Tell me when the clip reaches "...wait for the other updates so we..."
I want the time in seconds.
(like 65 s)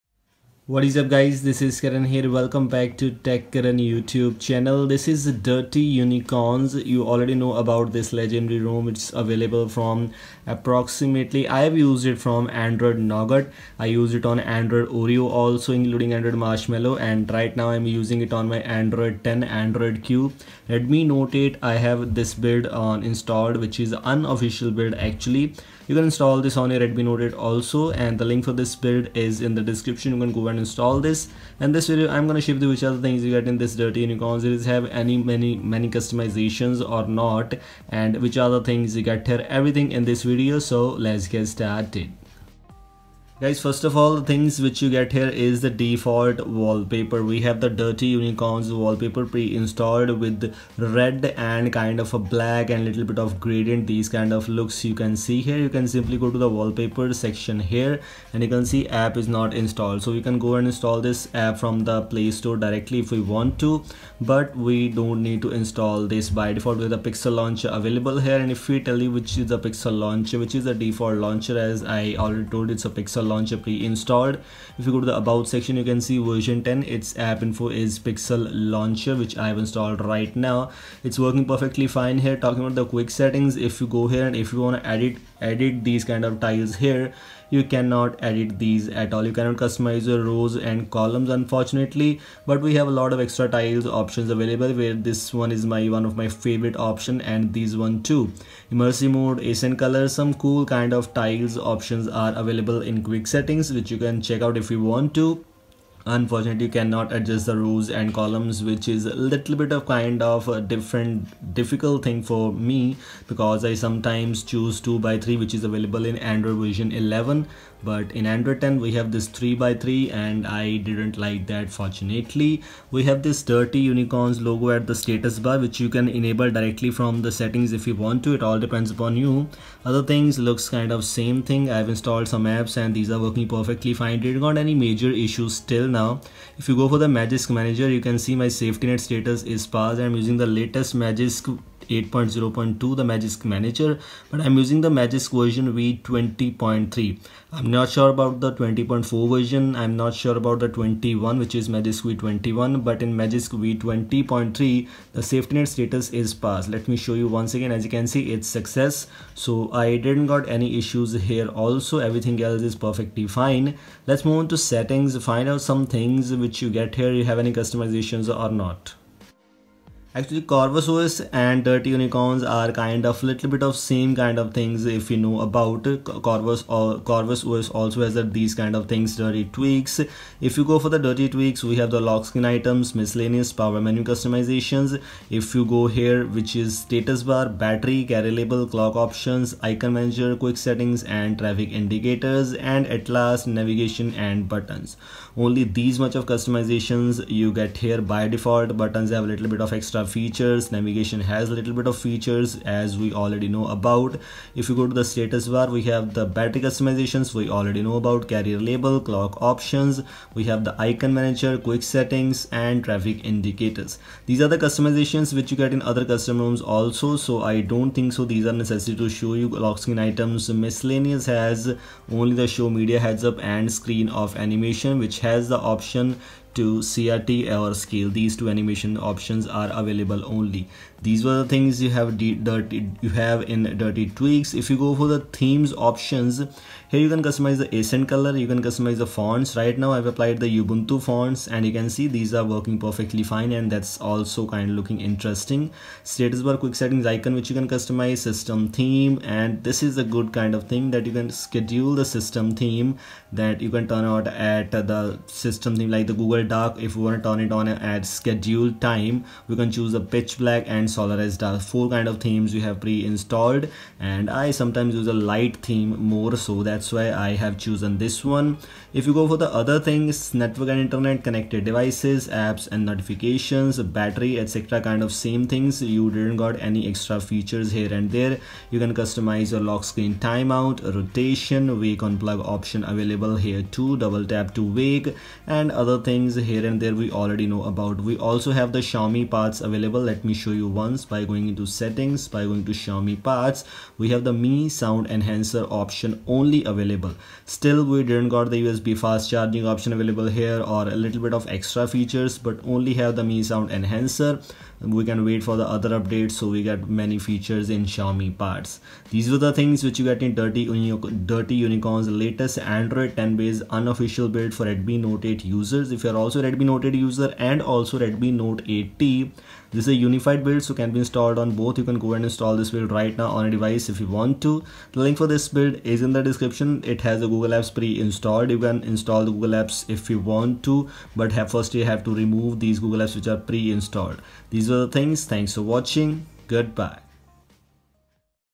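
305 s.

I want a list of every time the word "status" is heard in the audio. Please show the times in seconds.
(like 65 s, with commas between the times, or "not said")
124 s, 139 s, 155 s, 186 s, 205 s, 246 s.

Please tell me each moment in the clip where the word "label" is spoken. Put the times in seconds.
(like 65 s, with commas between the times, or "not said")
188 s, 208 s.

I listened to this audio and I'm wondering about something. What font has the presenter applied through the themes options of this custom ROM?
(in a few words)
Ubuntu.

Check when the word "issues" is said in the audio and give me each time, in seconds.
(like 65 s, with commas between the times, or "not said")
135 s, 160 s.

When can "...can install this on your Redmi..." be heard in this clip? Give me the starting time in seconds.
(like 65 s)
25 s.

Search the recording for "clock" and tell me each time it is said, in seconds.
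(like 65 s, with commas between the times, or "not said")
188 s, 208 s.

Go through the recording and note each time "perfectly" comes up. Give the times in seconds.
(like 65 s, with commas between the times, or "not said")
81 s, 133 s, 162 s, 242 s.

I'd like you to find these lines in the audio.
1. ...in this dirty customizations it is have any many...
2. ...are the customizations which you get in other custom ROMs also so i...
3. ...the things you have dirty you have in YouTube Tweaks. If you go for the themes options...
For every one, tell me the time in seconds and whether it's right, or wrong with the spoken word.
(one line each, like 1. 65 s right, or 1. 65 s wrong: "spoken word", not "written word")
1. 33 s wrong: "unicorns", not "customizations"
2. 214 s right
3. 231 s wrong: "Dirty", not "YouTube".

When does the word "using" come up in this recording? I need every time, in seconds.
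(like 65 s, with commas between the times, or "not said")
17 s, 140 s, 144 s.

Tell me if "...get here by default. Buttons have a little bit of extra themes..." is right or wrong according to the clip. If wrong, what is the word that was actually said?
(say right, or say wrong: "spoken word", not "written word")
wrong: "features", not "themes".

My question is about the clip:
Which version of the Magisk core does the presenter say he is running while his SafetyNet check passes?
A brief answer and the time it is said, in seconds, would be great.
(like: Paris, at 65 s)
v20.3, at 144 s.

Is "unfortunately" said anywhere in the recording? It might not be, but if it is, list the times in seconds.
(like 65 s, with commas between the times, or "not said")
91 s, 106 s.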